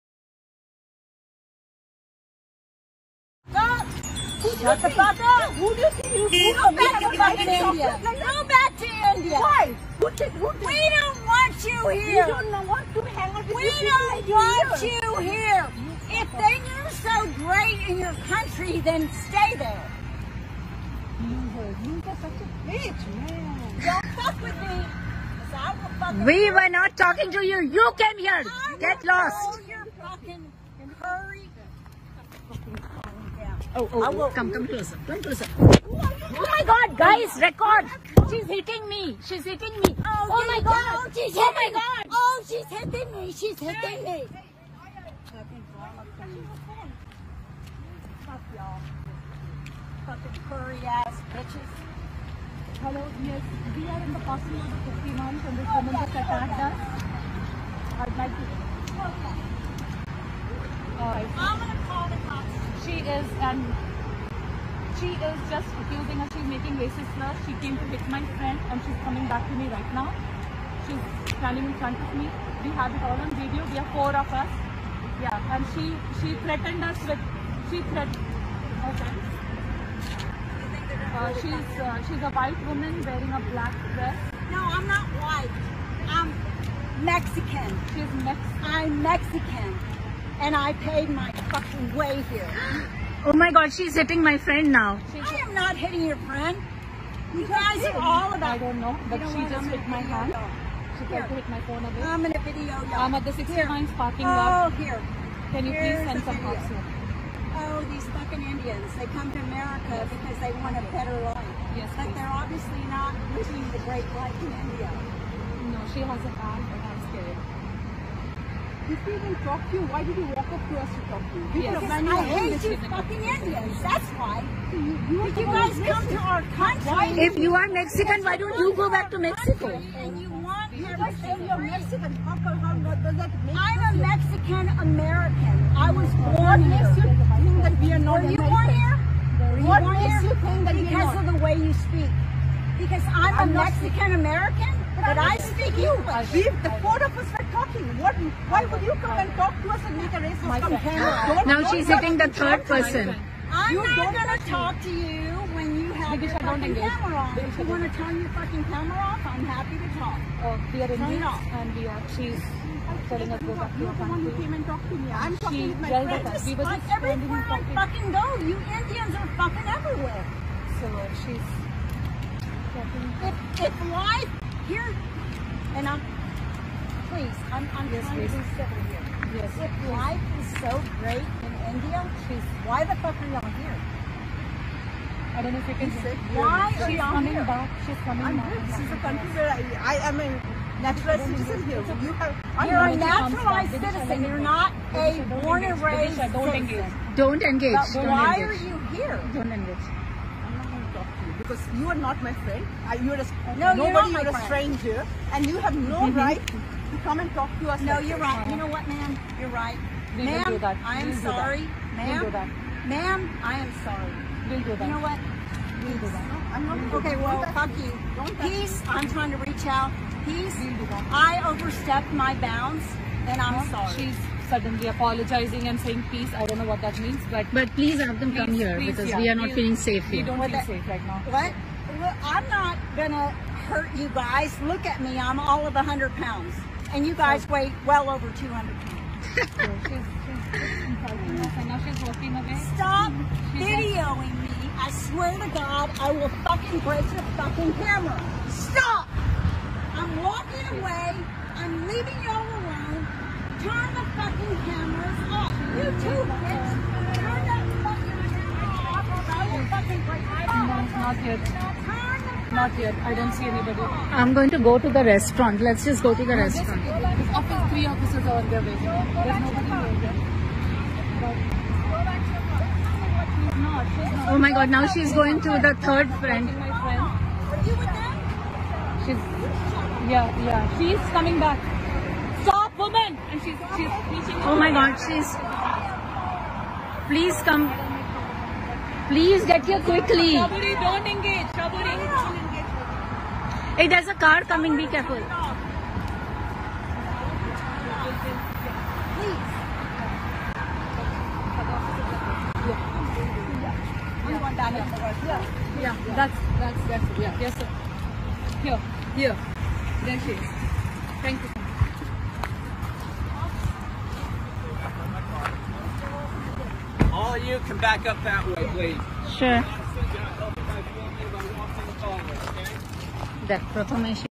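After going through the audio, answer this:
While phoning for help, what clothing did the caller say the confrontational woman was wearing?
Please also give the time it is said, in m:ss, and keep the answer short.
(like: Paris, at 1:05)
a black dress, at 1:23.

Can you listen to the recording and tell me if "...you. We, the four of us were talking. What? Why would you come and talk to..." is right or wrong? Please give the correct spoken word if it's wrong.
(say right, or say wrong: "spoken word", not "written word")
right.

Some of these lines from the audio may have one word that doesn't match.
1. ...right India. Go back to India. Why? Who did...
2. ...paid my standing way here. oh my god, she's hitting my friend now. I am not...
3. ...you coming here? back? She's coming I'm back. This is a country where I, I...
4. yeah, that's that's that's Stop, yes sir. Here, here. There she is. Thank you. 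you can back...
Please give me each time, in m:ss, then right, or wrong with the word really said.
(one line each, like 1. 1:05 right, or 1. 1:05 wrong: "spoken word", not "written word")
1. 0:07 right
2. 1:30 wrong: "fucking", not "standing"
3. 3:06 right
4. 5:05 wrong: "Yeah", not "Stop".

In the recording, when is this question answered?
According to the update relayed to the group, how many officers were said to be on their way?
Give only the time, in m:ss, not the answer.
4:27.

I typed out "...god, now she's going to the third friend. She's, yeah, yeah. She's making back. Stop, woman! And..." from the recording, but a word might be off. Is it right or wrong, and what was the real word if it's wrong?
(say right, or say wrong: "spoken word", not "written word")
wrong: "coming", not "making".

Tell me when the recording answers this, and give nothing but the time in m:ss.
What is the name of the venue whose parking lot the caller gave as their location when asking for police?
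1:43.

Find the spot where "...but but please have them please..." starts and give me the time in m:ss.
3:47.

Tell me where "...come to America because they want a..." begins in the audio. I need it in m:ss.
1:49.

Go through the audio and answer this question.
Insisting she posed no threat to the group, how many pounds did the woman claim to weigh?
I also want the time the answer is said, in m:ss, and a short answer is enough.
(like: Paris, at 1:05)
100, at 3:55.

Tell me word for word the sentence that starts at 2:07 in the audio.
If you are Mexican, why don't you go back to Mexico?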